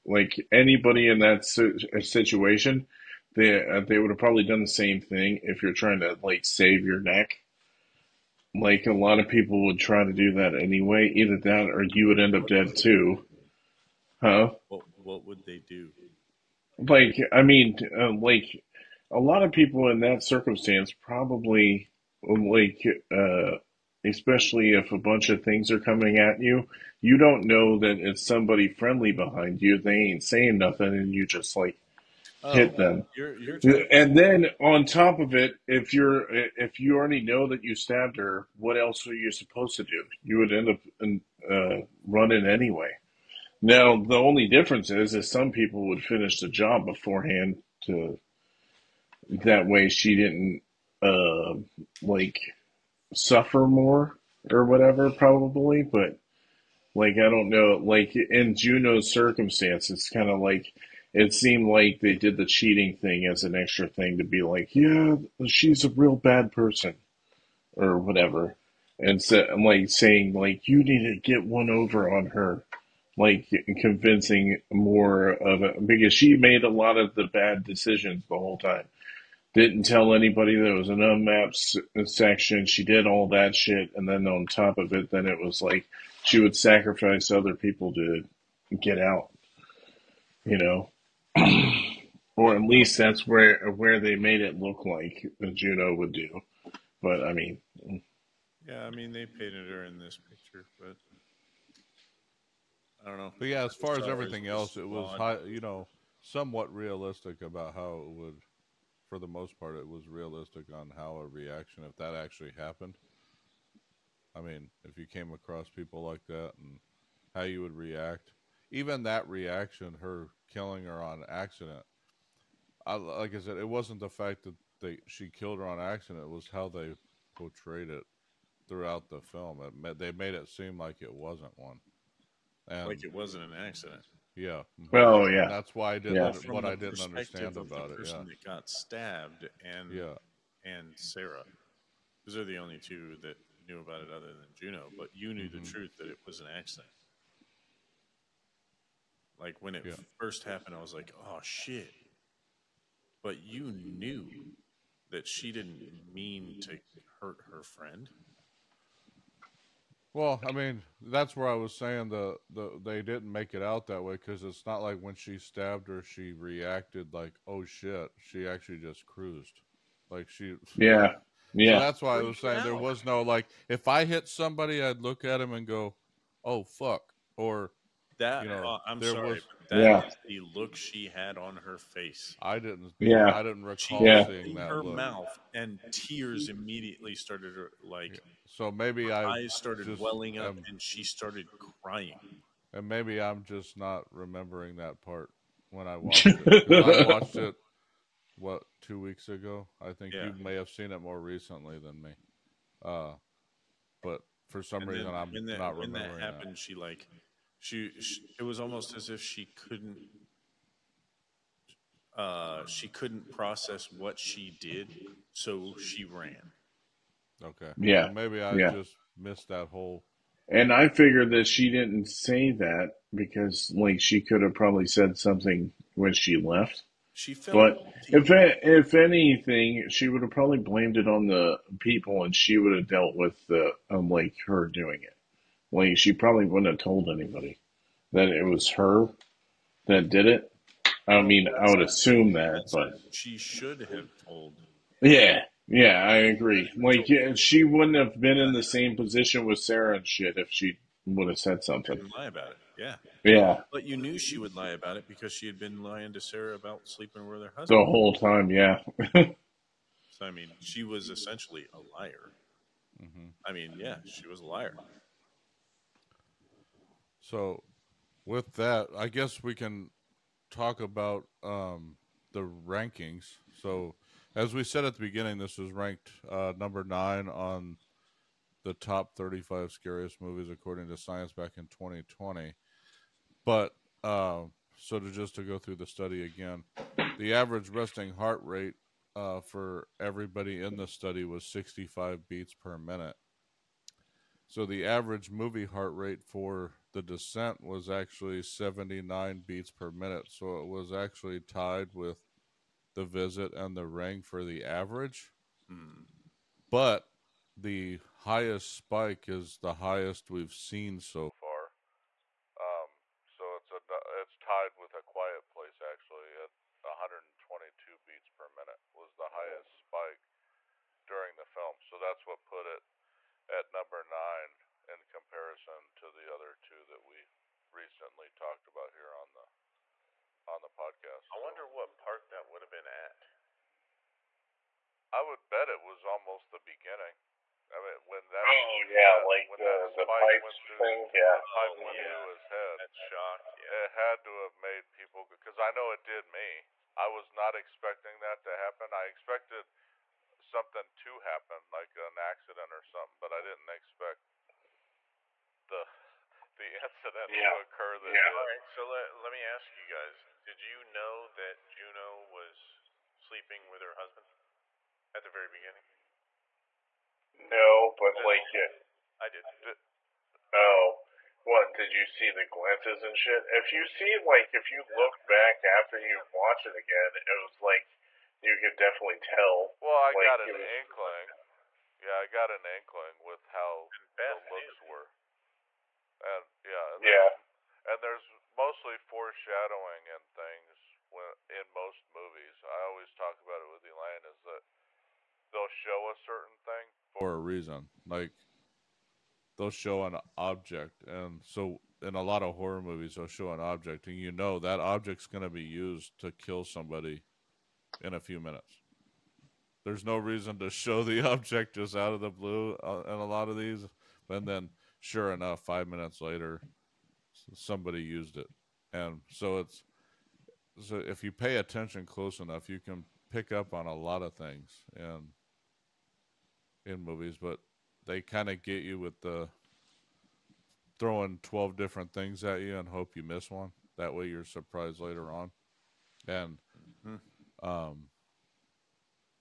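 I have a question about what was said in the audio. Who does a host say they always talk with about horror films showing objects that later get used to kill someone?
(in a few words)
Elaine.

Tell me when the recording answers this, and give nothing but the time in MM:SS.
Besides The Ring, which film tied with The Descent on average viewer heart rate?
05:02.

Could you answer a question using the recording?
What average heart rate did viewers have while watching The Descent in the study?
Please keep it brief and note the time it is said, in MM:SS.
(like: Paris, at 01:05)
79 beats per minute, at 04:58.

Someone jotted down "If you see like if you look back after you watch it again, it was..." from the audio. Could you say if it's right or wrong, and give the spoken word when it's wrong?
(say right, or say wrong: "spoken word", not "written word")
right.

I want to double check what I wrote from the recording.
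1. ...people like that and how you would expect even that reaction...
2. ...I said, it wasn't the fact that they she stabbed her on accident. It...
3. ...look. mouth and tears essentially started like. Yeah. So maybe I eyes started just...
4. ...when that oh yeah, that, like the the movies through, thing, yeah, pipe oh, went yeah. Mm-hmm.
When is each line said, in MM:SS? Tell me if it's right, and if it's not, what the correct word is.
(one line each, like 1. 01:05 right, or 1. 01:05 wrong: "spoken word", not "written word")
1. 01:55 wrong: "react", not "expect"
2. 02:03 wrong: "killed", not "stabbed"
3. 03:04 wrong: "immediately", not "essentially"
4. 05:38 wrong: "pipes", not "movies".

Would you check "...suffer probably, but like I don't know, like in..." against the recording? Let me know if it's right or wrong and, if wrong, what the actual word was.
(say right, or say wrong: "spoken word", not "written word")
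wrong: "whatever", not "suffer".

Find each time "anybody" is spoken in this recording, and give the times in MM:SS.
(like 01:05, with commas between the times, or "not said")
00:00, 01:20, 03:57.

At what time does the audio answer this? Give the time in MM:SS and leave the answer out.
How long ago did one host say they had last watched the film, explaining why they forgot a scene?
03:18.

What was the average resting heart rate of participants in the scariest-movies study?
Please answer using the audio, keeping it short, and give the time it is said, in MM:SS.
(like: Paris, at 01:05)
65 beats per minute, at 04:51.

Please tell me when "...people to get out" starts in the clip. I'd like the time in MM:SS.
01:27.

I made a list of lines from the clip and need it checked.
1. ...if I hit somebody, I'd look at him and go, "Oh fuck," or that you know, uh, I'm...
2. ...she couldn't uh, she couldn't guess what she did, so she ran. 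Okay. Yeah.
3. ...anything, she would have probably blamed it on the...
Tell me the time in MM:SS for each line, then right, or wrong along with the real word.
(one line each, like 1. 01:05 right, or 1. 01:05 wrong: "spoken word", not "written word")
1. 02:53 right
2. 03:29 wrong: "process", not "guess"
3. 03:48 right.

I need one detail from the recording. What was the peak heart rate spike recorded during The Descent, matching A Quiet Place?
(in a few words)
122 beats per minute.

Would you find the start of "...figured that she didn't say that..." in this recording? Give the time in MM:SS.
03:40.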